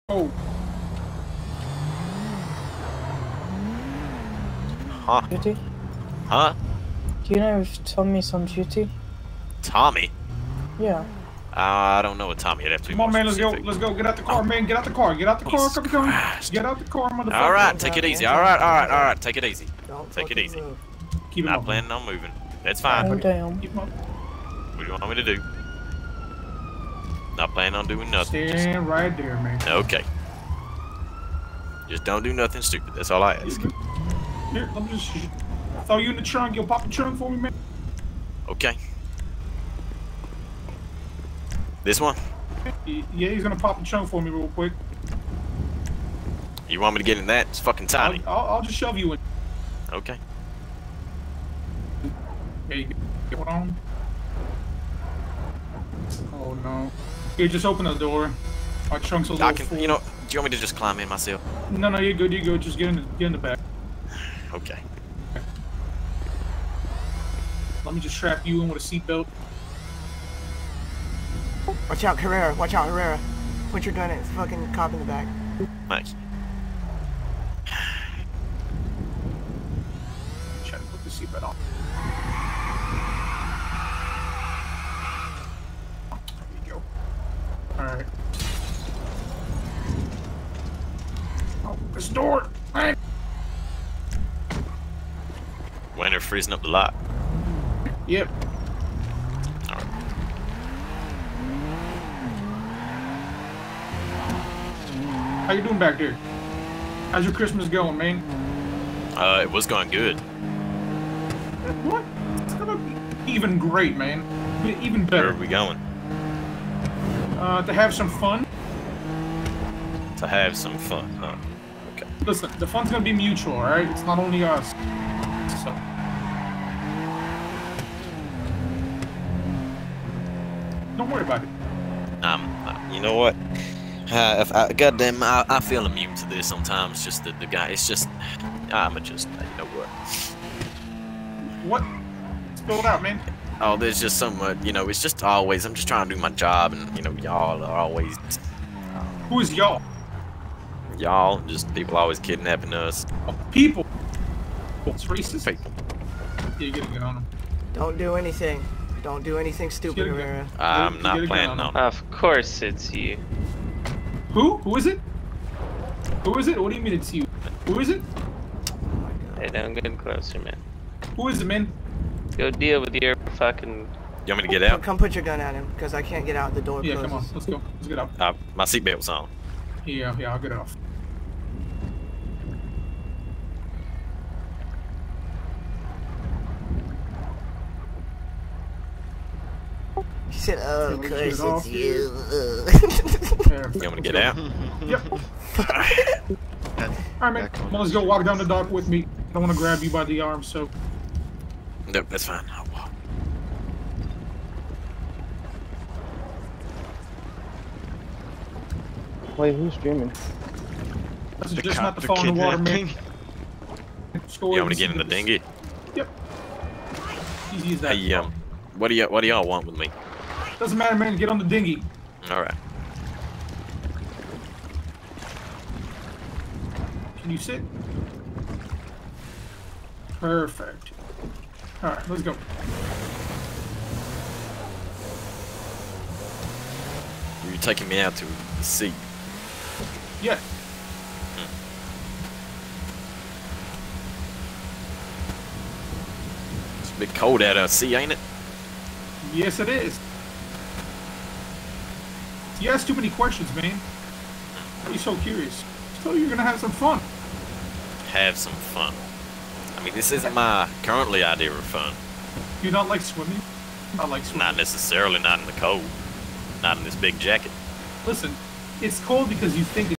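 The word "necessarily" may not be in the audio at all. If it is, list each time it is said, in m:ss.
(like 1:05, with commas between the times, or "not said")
4:24.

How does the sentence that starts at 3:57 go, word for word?
You're taking me out to the sea.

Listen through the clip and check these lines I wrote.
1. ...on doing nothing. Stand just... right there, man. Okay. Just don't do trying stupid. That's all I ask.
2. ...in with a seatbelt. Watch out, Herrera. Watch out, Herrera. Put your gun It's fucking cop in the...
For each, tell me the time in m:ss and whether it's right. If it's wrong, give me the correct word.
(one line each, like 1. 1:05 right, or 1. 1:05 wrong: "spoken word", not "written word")
1. 0:27 wrong: "nothing", not "trying"
2. 1:08 right.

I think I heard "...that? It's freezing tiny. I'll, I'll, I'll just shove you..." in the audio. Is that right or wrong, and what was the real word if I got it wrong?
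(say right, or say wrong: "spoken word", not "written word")
wrong: "fucking", not "freezing".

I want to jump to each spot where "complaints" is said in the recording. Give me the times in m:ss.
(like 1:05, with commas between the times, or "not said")
not said.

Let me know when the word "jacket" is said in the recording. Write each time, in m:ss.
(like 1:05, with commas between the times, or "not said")
4:27.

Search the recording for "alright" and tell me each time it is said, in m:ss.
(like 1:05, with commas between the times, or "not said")
2:03, 3:15.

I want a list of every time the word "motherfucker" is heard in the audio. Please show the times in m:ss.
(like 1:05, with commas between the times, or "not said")
0:17.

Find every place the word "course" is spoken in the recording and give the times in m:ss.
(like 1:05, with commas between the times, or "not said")
2:42, 3:11.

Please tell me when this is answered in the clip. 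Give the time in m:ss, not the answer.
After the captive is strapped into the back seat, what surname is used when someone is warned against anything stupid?
2:39.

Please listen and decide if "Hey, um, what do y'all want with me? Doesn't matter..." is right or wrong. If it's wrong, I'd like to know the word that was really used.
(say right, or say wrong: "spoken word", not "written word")
right.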